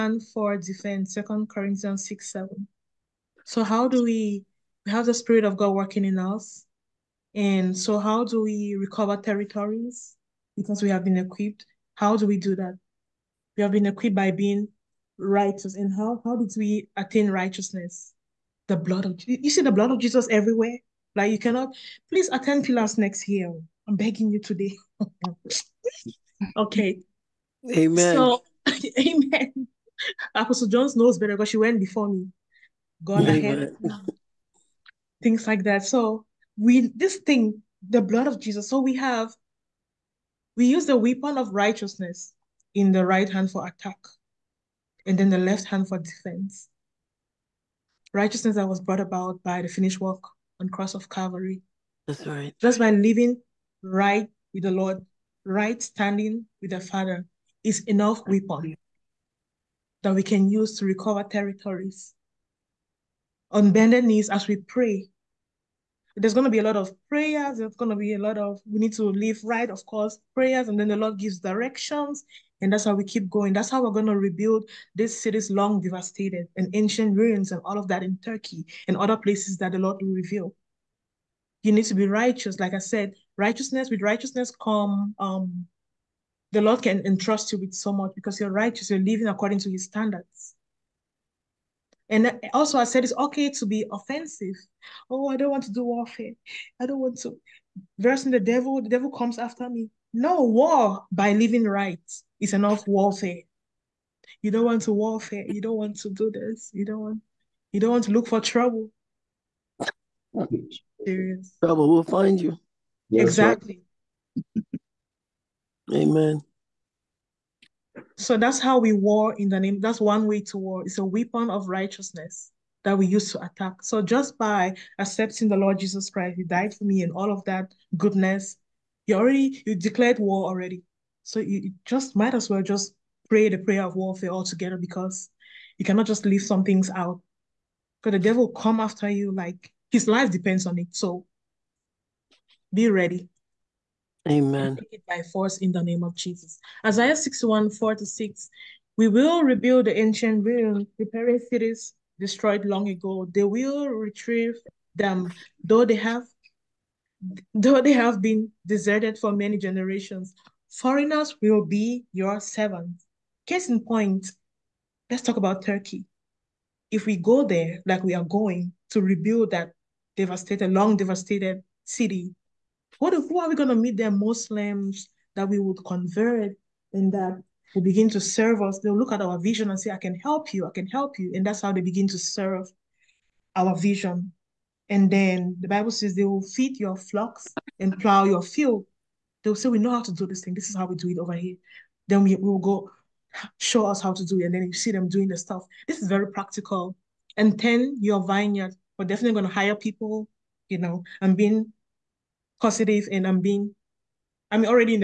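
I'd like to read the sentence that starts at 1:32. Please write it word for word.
And also, I said it's okay to be offensive.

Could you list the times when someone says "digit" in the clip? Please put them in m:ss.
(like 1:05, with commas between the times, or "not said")
not said.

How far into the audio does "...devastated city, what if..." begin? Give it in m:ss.
2:50.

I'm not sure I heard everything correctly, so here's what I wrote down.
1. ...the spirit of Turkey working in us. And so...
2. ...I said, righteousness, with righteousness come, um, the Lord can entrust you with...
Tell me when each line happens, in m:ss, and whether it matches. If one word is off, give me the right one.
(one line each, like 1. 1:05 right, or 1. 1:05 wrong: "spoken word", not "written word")
1. 0:05 wrong: "God", not "Turkey"
2. 1:22 right.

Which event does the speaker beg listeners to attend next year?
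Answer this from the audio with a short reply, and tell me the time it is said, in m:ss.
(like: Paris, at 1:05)
Pillars, at 0:22.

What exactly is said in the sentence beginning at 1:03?
On bended knees as we pray, there's going to be a lot of prayers.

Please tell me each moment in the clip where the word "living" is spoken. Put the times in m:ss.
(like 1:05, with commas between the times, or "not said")
0:52, 1:28, 1:41.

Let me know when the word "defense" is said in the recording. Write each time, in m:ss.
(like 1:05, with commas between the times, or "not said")
0:00, 0:45.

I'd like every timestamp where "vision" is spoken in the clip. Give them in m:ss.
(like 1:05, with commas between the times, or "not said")
2:59, 3:03.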